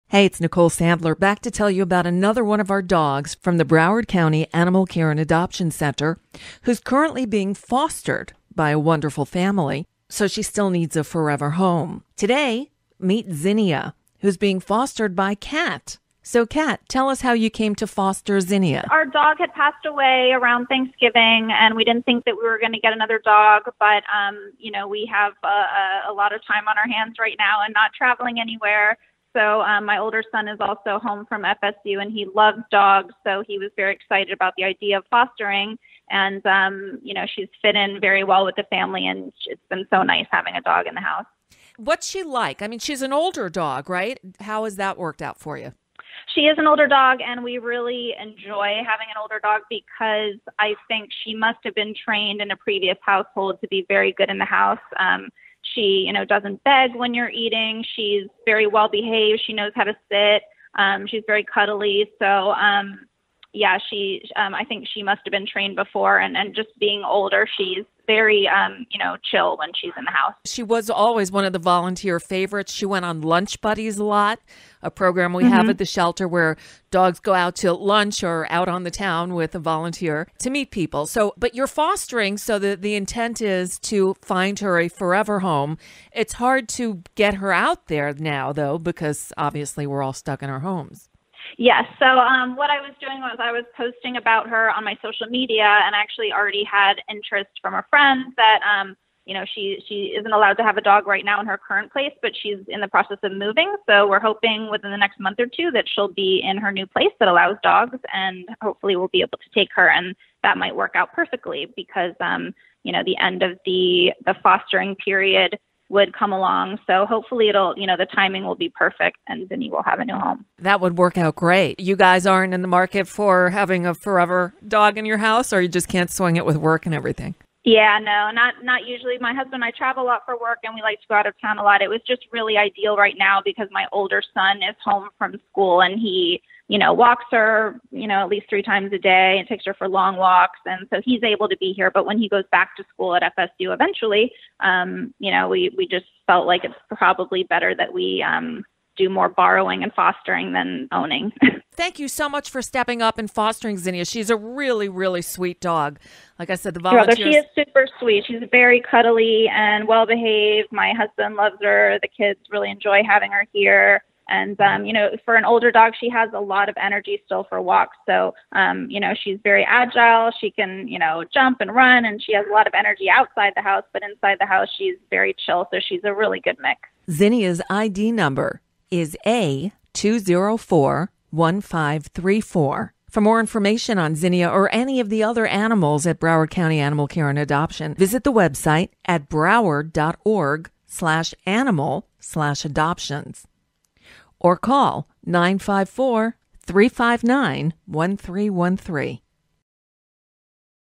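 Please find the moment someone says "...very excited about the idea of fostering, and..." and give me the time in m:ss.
0:33.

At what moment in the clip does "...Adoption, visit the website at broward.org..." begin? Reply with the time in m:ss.
3:07.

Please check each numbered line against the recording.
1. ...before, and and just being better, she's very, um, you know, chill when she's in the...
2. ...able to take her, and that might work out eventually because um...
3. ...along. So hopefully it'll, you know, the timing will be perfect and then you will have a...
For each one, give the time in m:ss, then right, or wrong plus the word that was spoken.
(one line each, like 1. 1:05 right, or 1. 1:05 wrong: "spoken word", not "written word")
1. 1:05 wrong: "older", not "better"
2. 1:49 wrong: "perfectly", not "eventually"
3. 1:56 right.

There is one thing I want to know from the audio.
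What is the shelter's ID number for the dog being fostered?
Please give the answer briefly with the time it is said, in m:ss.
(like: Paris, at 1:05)
A2041534, at 2:59.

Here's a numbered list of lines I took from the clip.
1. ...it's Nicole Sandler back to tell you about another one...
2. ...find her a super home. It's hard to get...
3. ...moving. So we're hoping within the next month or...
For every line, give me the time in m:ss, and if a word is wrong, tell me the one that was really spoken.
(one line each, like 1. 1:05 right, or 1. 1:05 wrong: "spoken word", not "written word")
1. 0:00 right
2. 1:24 wrong: "forever", not "super"
3. 1:43 right.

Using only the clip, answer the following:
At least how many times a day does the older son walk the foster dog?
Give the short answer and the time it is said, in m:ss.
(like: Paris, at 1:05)
3, at 2:18.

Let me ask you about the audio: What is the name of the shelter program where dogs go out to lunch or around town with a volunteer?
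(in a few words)
Lunch Buddies.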